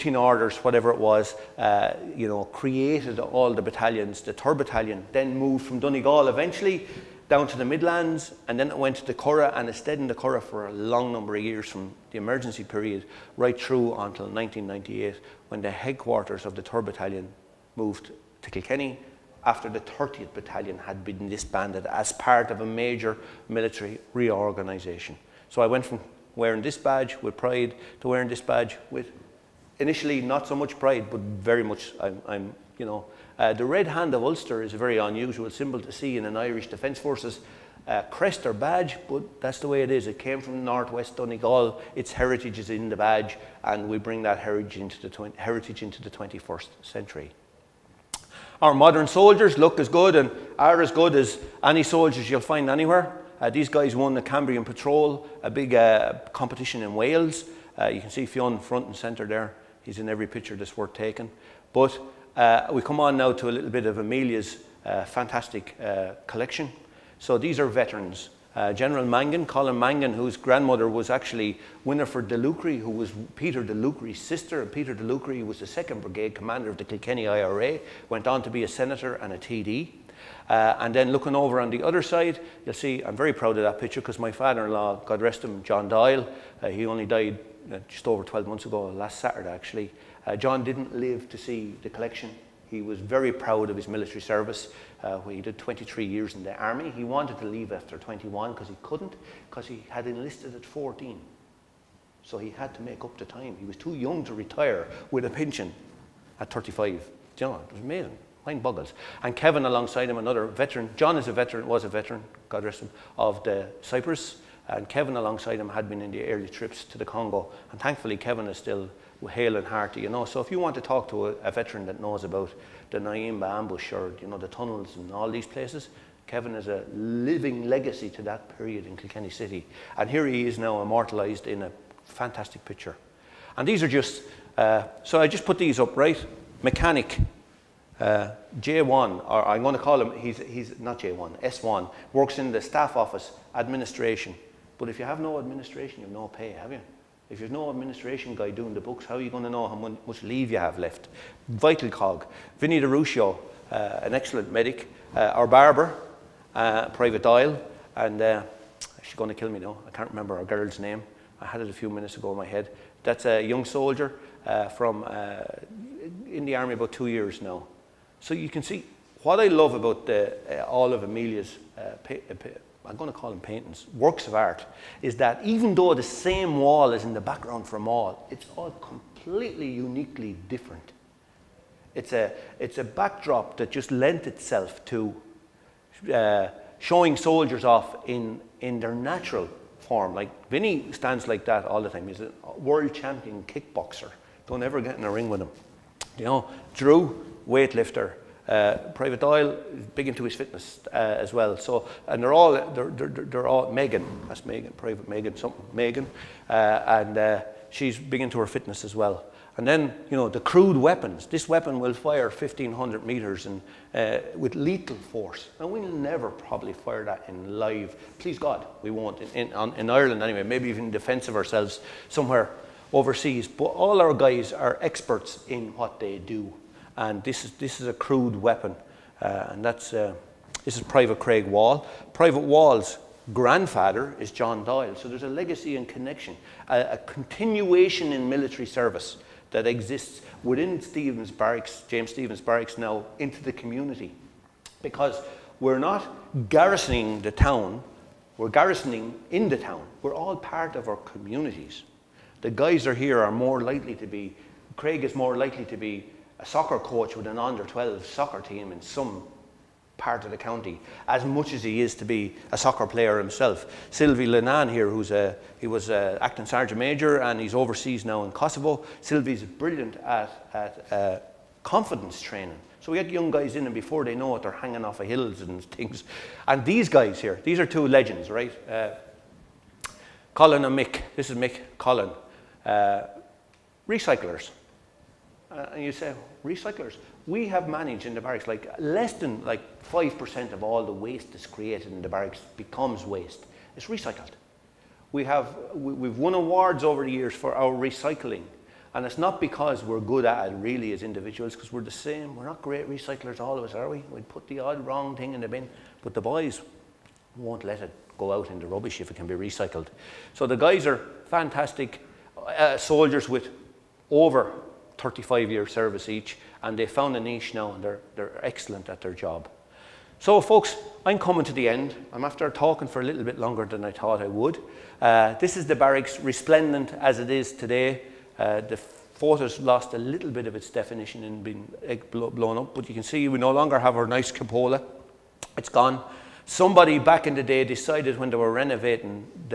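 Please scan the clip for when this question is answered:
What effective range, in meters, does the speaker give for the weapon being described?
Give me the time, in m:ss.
3:32.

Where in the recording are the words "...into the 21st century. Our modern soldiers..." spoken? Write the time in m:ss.
0:45.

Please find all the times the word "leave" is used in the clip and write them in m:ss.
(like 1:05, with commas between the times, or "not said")
1:37, 2:30.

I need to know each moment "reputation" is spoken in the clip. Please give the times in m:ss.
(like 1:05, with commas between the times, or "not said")
not said.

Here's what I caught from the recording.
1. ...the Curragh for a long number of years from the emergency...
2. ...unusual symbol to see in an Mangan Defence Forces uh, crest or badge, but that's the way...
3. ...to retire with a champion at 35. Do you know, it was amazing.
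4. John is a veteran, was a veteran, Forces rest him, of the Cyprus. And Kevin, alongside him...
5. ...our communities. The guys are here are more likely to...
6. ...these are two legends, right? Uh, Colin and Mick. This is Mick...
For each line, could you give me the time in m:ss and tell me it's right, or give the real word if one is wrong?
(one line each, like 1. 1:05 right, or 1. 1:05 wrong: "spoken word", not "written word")
1. 0:10 right
2. 0:34 wrong: "Irish", not "Mangan"
3. 1:44 wrong: "pension", not "champion"
4. 1:50 wrong: "God", not "Forces"
5. 4:10 right
6. 4:37 right.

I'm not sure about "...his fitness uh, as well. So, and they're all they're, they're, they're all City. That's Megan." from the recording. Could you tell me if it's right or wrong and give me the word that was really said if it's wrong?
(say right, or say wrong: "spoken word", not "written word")
wrong: "Megan", not "City".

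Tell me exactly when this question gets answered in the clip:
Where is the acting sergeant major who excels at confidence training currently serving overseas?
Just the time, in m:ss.
4:28.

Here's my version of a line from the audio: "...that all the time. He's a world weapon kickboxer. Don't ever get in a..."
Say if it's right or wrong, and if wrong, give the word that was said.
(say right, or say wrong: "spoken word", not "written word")
wrong: "champion", not "weapon".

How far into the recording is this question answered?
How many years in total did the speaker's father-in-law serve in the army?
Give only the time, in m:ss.
1:35.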